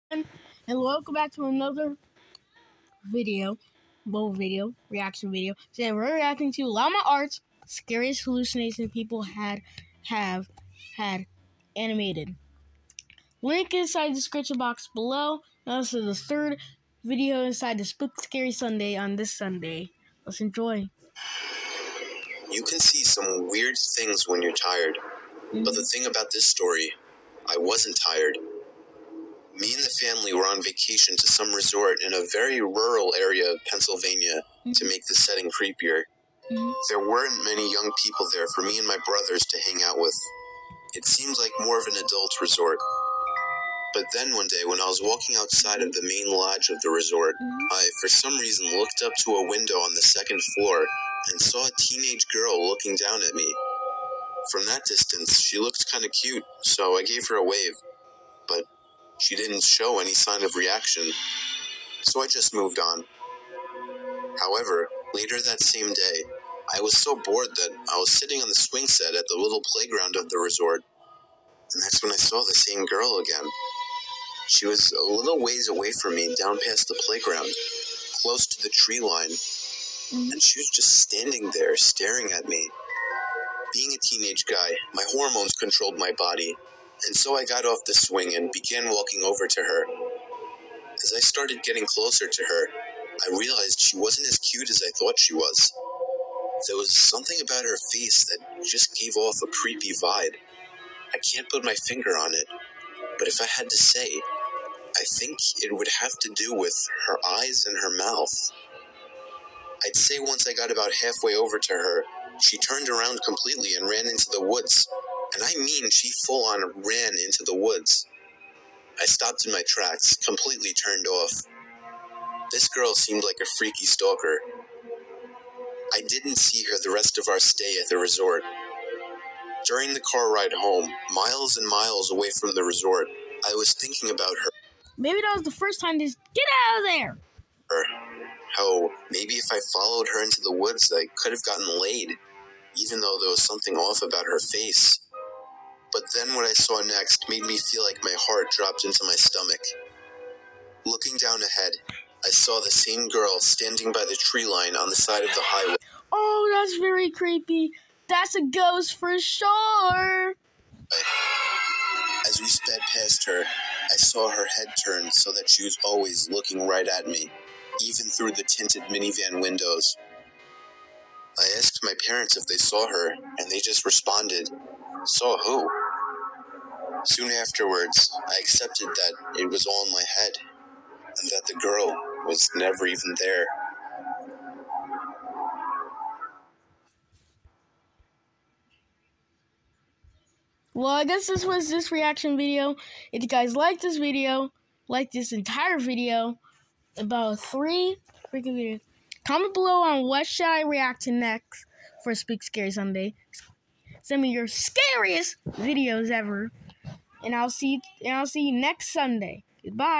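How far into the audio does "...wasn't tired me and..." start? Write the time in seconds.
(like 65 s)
27 s.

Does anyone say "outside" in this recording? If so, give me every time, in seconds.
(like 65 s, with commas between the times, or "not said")
45 s.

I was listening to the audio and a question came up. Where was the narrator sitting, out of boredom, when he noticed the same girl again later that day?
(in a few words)
swing set.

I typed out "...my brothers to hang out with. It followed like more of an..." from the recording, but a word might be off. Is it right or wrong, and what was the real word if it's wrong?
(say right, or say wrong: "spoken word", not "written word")
wrong: "seemed", not "followed".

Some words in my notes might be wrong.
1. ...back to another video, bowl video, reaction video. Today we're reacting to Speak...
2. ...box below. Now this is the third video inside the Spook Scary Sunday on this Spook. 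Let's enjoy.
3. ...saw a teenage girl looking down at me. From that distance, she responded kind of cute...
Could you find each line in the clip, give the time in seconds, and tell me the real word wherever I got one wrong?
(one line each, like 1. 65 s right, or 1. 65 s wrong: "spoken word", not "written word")
1. 1 s wrong: "Llama", not "Speak"
2. 14 s wrong: "Sunday", not "Spook"
3. 51 s wrong: "looked", not "responded".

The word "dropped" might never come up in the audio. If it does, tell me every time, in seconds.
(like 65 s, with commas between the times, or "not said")
148 s.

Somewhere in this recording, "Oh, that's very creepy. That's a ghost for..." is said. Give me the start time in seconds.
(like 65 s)
156 s.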